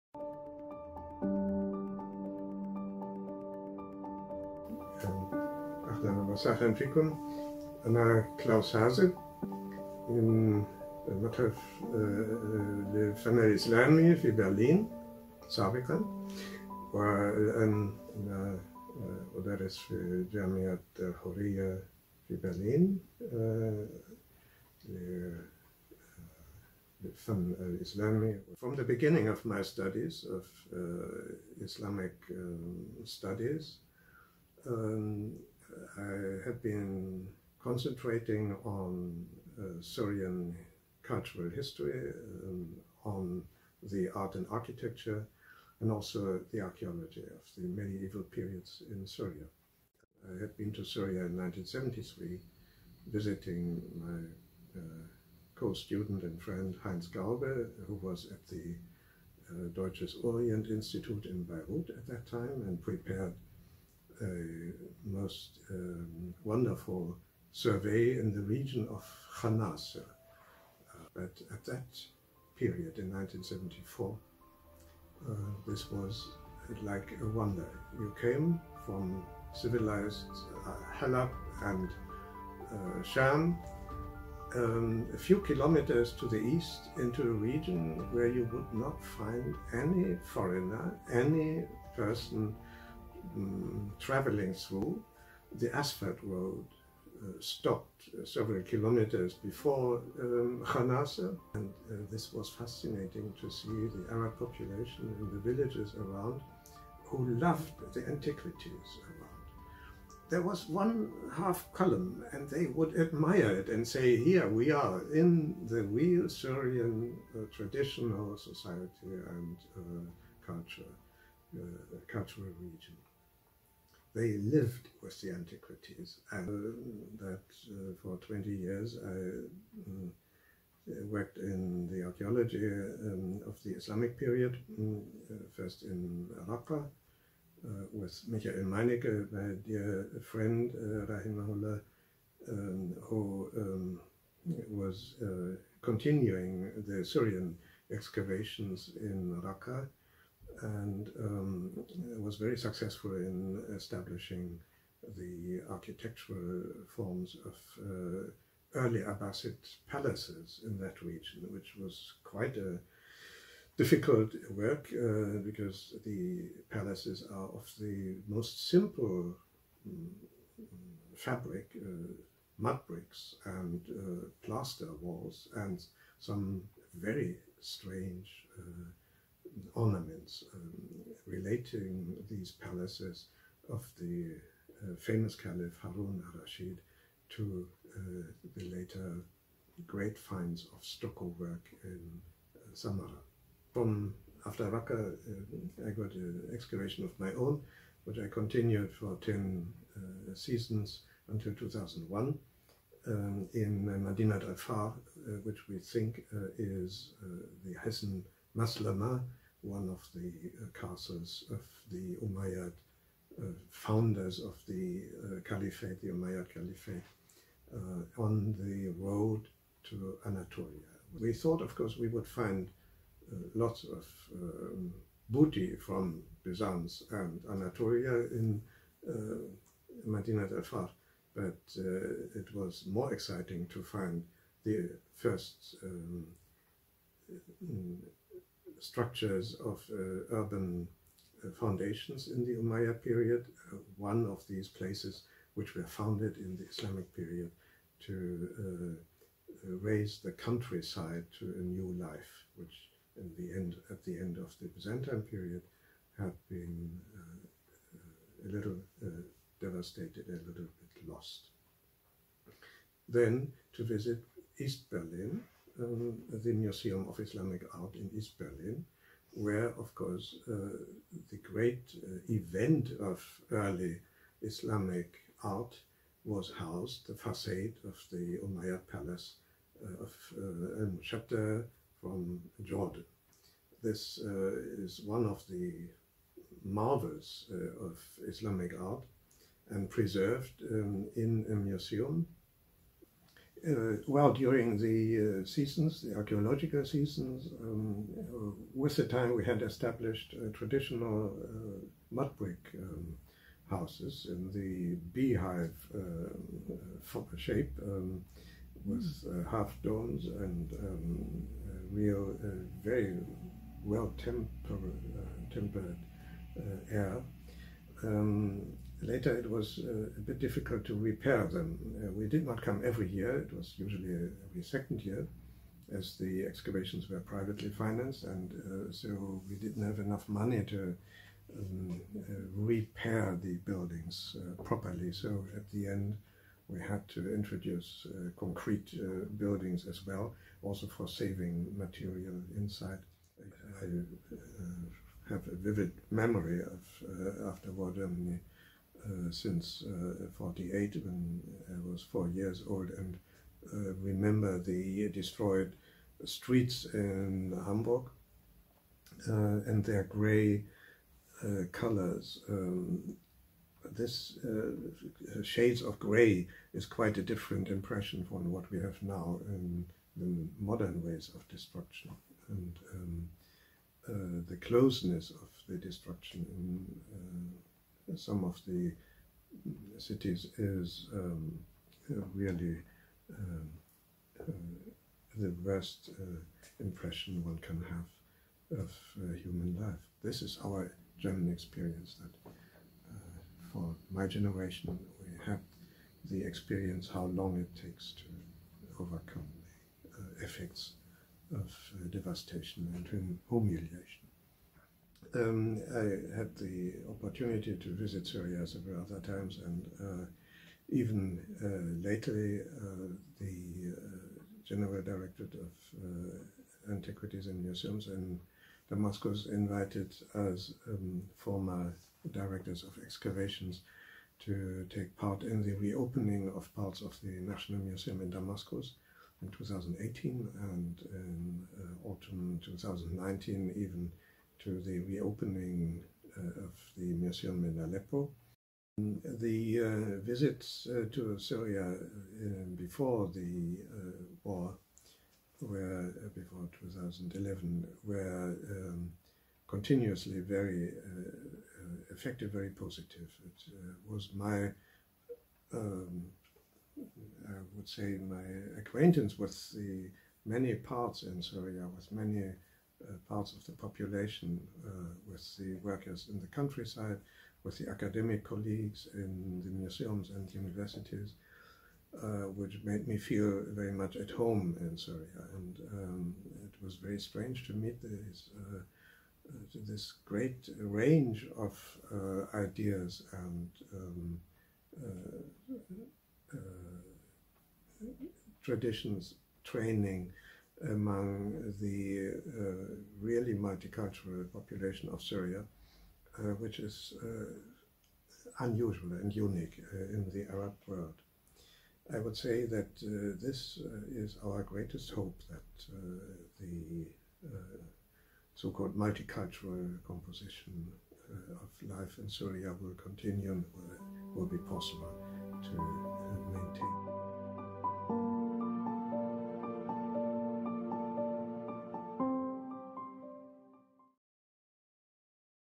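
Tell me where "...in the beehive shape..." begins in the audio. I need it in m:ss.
5:04.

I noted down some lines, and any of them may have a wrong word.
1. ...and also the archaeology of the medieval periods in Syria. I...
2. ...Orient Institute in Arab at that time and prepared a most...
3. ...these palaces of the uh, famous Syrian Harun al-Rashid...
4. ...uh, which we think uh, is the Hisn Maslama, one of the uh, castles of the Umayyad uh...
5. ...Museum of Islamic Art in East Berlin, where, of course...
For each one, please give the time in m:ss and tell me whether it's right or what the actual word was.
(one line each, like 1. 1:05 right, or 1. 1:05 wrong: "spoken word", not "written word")
1. 0:45 right
2. 1:00 wrong: "Beirut", not "Arab"
3. 3:02 wrong: "Caliph", not "Syrian"
4. 3:25 right
5. 4:26 right.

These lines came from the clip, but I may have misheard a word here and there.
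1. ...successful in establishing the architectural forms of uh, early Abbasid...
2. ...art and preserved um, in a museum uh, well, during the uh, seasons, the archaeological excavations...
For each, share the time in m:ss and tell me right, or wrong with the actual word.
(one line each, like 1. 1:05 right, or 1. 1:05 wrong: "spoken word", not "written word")
1. 2:32 right
2. 4:48 wrong: "seasons", not "excavations".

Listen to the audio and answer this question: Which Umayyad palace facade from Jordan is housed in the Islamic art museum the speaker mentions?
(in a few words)
Al-Mushatta.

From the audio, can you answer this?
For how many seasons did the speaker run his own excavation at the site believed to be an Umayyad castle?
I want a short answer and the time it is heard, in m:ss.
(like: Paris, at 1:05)
10, at 3:19.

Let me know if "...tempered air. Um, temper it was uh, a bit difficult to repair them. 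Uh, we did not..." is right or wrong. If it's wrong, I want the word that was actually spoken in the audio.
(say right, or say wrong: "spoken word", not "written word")
wrong: "later", not "temper".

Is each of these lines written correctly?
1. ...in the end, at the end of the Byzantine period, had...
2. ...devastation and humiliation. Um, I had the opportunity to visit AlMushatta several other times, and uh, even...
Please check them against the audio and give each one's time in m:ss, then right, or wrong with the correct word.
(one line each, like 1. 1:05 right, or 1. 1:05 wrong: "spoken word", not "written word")
1. 4:13 right
2. 6:42 wrong: "Syria", not "AlMushatta".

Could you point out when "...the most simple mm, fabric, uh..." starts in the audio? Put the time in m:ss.
2:47.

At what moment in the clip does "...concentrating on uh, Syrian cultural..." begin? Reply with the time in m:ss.
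0:37.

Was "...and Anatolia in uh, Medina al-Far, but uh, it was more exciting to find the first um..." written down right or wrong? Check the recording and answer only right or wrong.
right.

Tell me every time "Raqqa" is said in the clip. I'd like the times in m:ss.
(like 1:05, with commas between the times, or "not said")
2:16, 2:29, 3:14.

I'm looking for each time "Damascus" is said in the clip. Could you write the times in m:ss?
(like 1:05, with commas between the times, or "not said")
6:58, 7:08.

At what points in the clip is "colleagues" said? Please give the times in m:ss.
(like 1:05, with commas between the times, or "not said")
7:48.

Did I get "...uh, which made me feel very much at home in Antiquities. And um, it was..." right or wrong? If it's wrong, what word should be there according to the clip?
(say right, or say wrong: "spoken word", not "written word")
wrong: "Syria", not "Antiquities".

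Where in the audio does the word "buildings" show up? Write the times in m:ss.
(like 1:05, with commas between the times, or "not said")
5:33, 5:39.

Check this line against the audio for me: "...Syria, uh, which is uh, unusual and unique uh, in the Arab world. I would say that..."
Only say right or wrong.
right.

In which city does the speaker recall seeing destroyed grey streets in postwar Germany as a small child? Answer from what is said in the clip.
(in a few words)
Hamburg.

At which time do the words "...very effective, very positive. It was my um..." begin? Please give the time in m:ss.
7:30.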